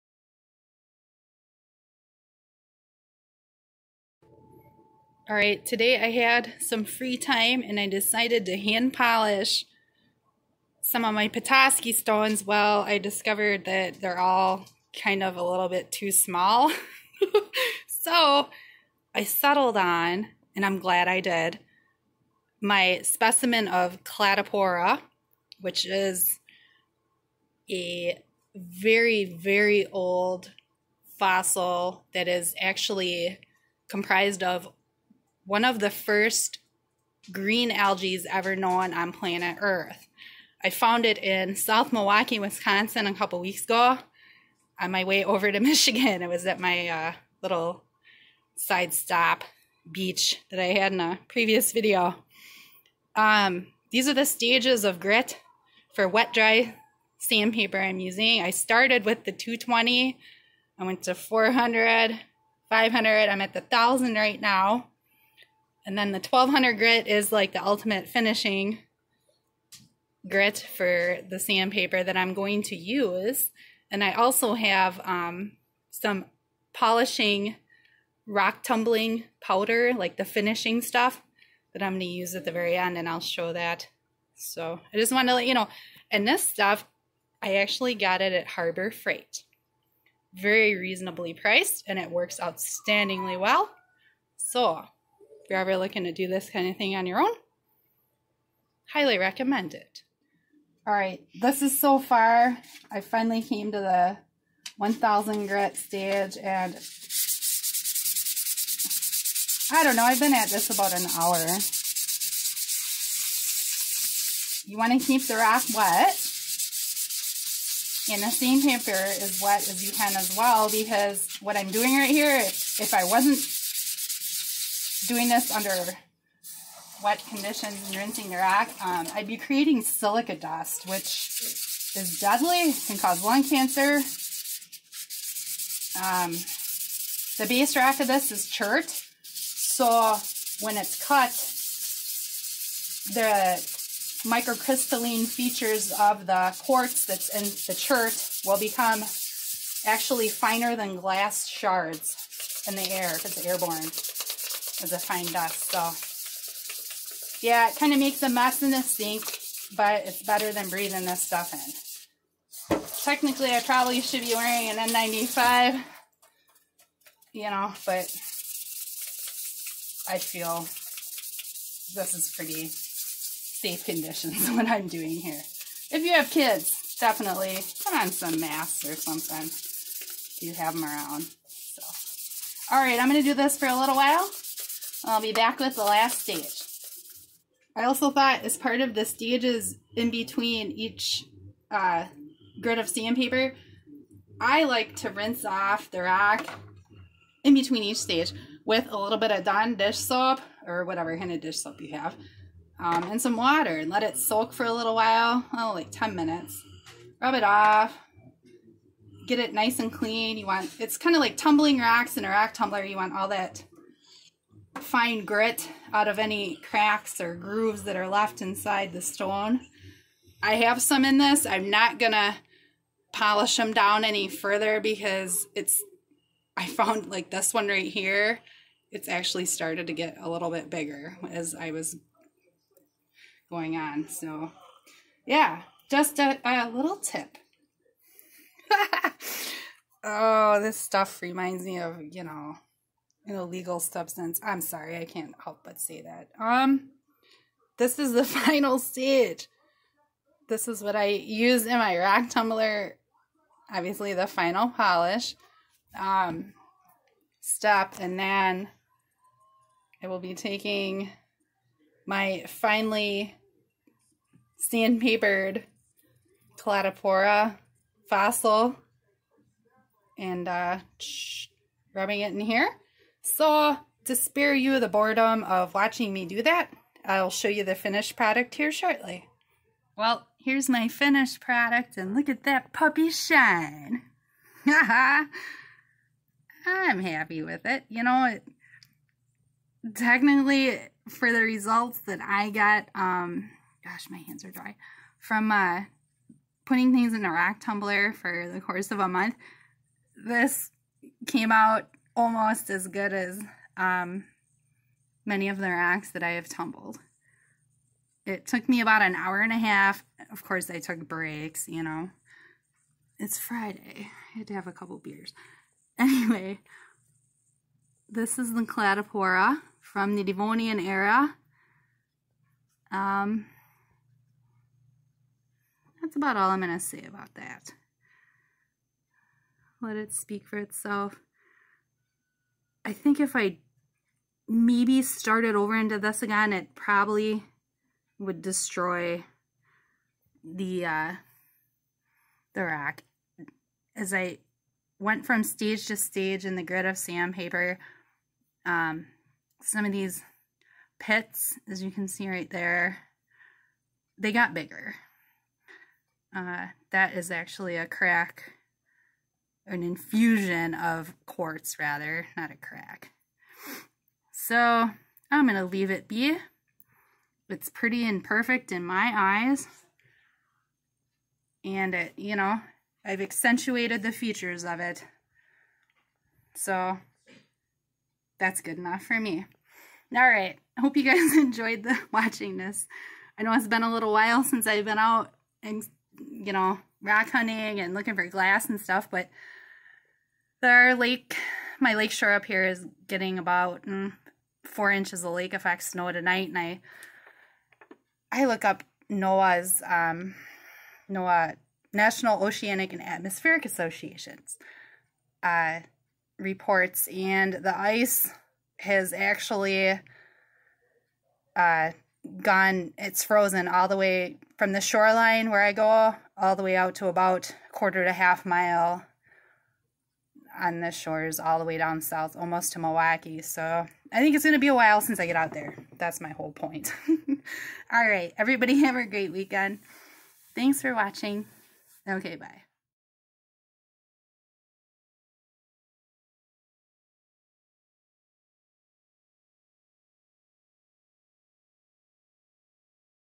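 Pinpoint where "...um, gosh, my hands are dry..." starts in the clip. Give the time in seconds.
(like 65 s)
292 s.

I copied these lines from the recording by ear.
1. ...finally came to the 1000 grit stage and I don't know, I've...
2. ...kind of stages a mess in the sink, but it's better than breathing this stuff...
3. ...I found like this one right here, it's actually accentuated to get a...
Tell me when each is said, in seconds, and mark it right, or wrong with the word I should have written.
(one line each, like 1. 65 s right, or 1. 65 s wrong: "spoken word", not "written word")
1. 103 s right
2. 157 s wrong: "makes", not "stages"
3. 226 s wrong: "started", not "accentuated".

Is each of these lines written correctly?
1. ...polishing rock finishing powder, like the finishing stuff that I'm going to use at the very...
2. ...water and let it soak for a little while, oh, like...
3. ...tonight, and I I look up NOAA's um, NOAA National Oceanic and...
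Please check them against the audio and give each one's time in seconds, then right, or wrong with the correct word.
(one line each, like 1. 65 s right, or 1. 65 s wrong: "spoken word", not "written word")
1. 76 s wrong: "tumbling", not "finishing"
2. 203 s right
3. 396 s right.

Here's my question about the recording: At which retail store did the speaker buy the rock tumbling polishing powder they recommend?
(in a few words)
Harbor Freight.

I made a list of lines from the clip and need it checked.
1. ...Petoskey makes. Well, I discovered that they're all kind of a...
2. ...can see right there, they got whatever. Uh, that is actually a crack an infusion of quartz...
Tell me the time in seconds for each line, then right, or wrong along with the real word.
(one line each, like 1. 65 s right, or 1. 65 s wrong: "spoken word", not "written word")
1. 11 s wrong: "stones", not "makes"
2. 351 s wrong: "bigger", not "whatever".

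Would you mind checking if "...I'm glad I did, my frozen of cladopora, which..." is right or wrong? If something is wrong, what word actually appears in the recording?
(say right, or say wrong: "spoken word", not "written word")
wrong: "specimen", not "frozen".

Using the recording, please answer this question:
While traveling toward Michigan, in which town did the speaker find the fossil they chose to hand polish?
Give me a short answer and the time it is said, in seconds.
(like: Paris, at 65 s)
South Milwaukee, at 41 s.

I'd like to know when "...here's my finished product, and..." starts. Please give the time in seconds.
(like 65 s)
280 s.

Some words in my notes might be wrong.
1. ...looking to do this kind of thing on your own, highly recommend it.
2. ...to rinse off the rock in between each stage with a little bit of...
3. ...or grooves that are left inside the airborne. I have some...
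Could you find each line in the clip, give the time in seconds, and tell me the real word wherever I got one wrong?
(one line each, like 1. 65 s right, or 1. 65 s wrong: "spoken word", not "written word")
1. 95 s right
2. 194 s right
3. 217 s wrong: "stone", not "airborne".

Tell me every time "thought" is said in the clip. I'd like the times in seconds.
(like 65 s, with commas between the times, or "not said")
188 s.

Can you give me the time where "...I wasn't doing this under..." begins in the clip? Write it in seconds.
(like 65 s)
122 s.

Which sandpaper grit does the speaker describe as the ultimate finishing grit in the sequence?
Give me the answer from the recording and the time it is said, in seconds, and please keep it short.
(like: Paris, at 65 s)
1200, at 66 s.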